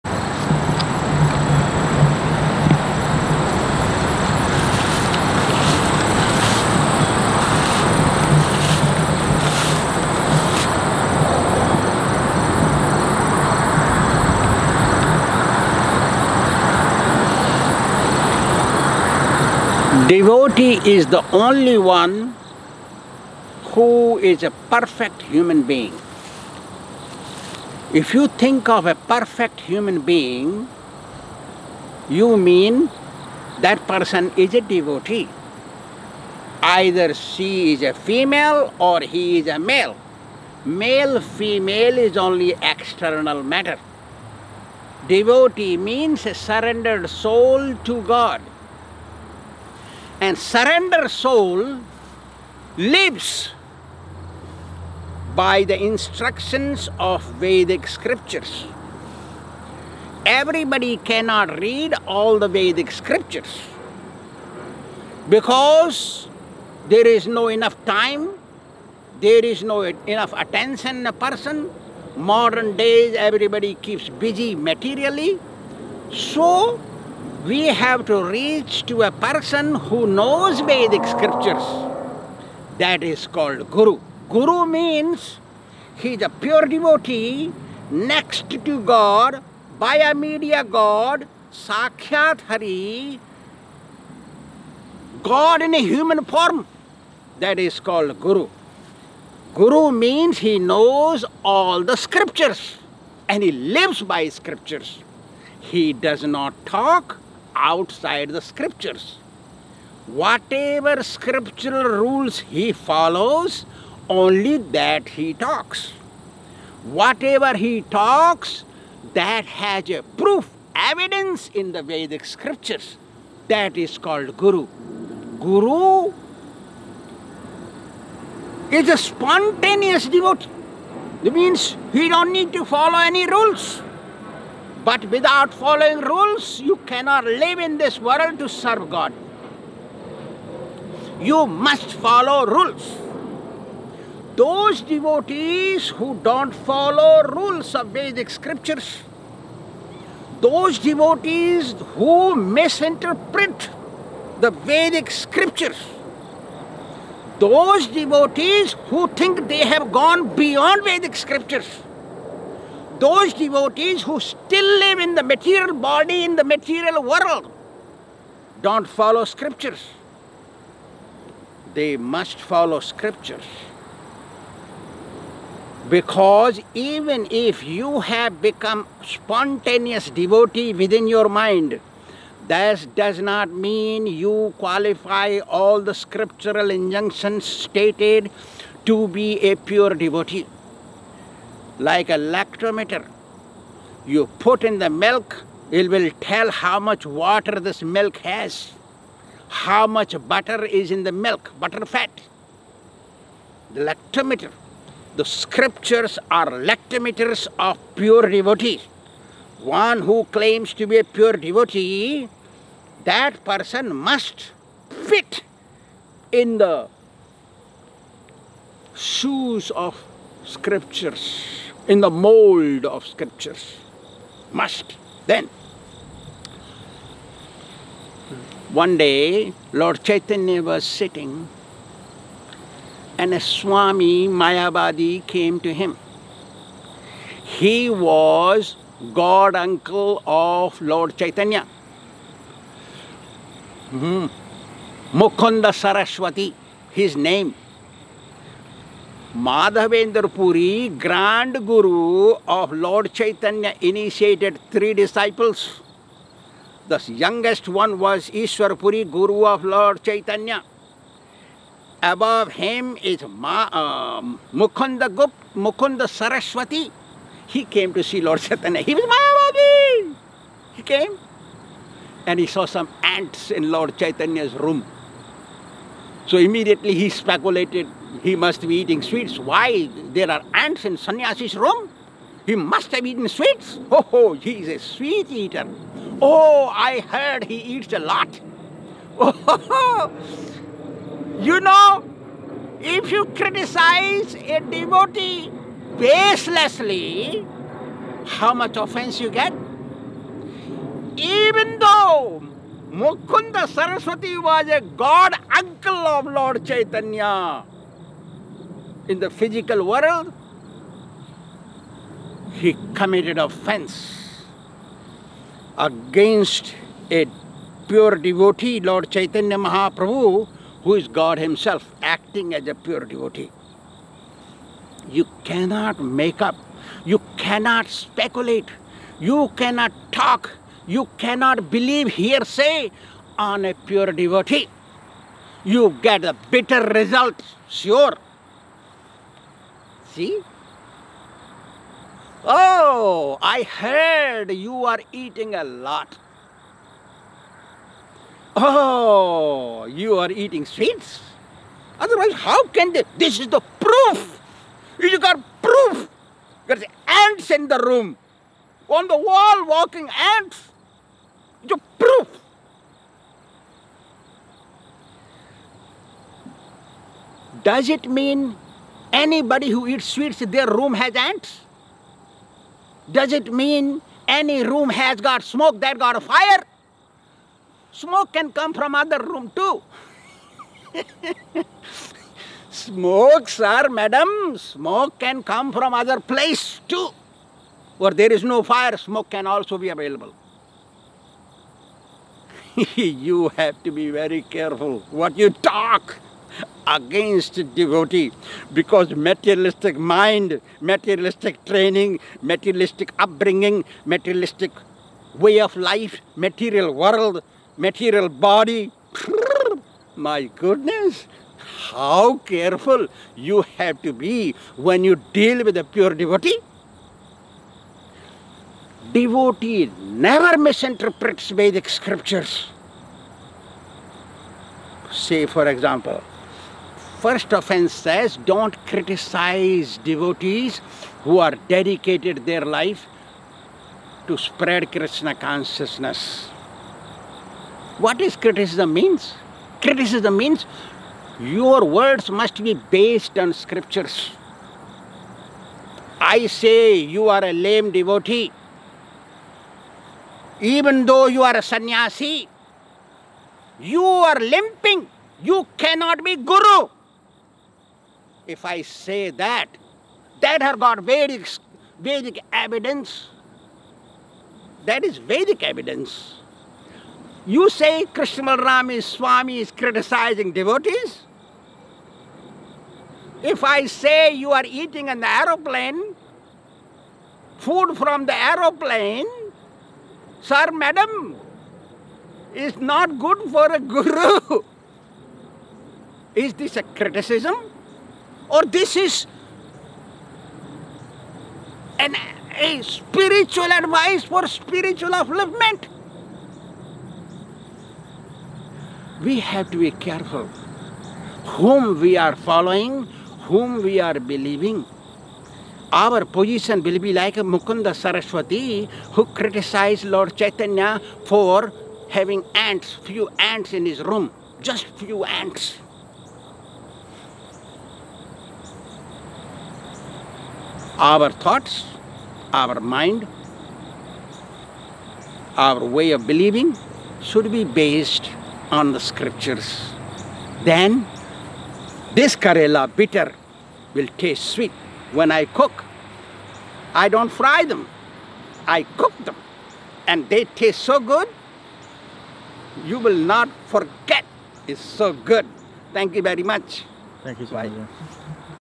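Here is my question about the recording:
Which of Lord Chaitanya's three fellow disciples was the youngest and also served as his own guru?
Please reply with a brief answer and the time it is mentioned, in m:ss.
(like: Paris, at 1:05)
Ishwar Puri, at 4:18.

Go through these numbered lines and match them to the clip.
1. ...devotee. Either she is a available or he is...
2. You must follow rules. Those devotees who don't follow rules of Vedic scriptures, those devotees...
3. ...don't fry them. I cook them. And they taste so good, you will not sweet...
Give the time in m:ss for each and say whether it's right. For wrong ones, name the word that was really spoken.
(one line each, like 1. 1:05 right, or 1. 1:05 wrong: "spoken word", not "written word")
1. 0:34 wrong: "female", not "available"
2. 2:21 right
3. 8:57 wrong: "forget", not "sweet".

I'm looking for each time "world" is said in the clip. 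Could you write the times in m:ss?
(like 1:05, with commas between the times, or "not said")
2:17, 2:47, 5:09, 6:46.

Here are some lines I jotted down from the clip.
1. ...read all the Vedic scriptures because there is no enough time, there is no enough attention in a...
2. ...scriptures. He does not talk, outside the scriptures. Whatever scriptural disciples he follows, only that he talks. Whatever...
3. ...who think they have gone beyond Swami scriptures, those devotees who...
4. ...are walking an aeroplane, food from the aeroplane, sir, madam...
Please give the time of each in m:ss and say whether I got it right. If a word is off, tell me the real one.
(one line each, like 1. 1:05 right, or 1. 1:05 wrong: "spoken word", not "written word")
1. 1:01 right
2. 1:44 wrong: "rules", not "disciples"
3. 2:38 wrong: "Vedic", not "Swami"
4. 7:54 wrong: "eating", not "walking".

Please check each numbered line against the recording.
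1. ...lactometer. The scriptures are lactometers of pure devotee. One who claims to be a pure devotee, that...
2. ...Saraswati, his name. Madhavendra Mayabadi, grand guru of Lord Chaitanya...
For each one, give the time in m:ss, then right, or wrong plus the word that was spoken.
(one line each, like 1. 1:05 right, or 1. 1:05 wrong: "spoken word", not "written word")
1. 3:23 right
2. 4:05 wrong: "Puri", not "Mayabadi".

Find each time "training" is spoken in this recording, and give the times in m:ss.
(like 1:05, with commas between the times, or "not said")
6:41.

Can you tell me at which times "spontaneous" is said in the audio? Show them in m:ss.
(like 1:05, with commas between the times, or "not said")
2:08, 2:59.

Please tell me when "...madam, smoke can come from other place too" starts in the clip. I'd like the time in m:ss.
6:23.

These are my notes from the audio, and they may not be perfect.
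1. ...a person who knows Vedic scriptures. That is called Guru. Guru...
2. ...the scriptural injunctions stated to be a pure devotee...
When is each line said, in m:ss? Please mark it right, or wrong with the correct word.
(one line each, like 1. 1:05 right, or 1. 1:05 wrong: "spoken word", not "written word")
1. 1:19 right
2. 3:05 right.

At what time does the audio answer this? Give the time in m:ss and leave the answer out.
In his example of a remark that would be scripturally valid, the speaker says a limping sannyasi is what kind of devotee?
7:26.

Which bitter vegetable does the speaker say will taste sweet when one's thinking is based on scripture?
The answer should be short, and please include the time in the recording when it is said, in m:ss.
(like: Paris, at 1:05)
Karela, at 8:52.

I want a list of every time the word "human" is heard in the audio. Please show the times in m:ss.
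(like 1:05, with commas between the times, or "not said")
0:25, 0:29, 1:35.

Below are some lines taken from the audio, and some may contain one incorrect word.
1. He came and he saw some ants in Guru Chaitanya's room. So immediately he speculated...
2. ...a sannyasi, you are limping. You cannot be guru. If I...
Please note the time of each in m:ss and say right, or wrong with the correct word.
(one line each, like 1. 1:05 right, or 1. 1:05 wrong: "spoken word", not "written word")
1. 4:30 wrong: "Lord", not "Guru"
2. 7:31 right.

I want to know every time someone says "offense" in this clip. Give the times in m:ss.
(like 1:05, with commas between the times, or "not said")
4:58, 5:13, 7:07.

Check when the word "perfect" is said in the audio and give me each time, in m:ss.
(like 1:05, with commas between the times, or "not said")
0:24, 0:28.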